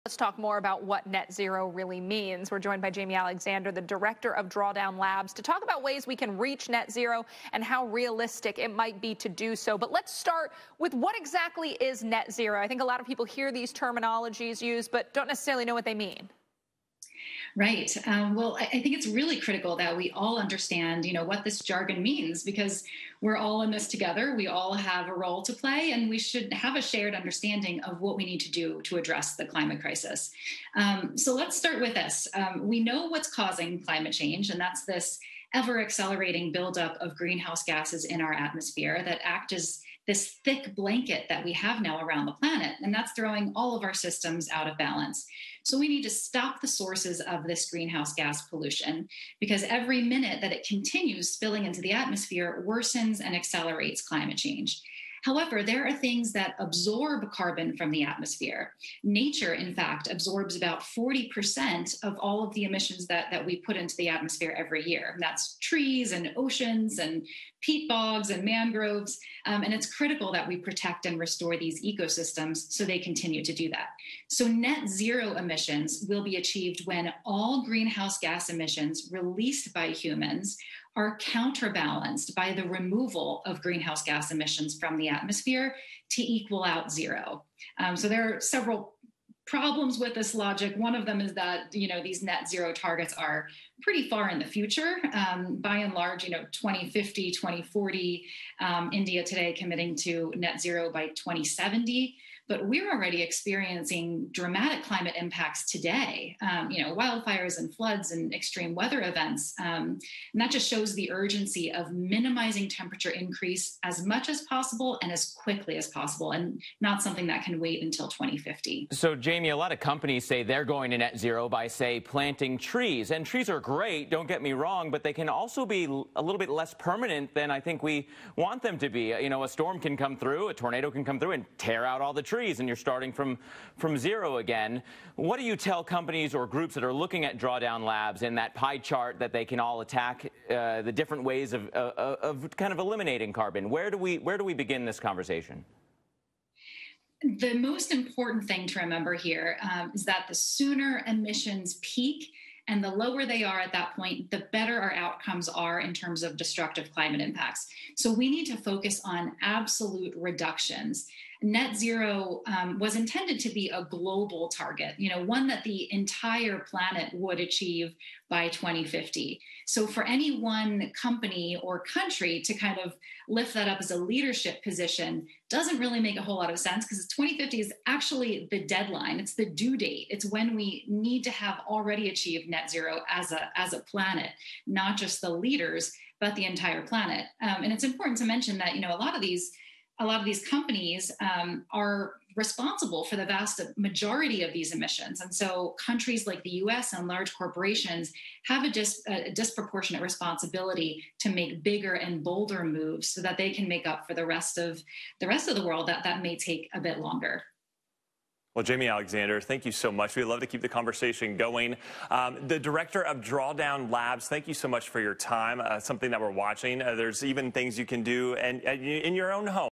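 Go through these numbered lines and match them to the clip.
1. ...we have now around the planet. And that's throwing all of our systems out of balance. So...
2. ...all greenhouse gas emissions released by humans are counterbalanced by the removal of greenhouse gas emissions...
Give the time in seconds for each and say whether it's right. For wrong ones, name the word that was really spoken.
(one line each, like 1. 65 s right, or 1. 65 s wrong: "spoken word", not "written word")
1. 41 s right
2. 77 s right.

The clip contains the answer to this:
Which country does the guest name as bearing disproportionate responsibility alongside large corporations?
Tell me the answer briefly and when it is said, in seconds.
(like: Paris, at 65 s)
US, at 196 s.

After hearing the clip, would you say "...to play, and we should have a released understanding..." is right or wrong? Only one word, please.
wrong.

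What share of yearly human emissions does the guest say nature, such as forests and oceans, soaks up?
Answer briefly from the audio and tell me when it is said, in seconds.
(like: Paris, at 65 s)
40%, at 60 s.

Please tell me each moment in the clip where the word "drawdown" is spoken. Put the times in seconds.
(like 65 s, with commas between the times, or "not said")
4 s, 137 s, 213 s.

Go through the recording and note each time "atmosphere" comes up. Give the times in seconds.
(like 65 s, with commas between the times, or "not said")
38 s, 51 s, 58 s, 64 s, 85 s.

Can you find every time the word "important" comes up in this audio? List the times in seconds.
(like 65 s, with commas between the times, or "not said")
147 s, 187 s.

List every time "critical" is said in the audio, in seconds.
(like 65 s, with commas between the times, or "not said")
19 s, 69 s.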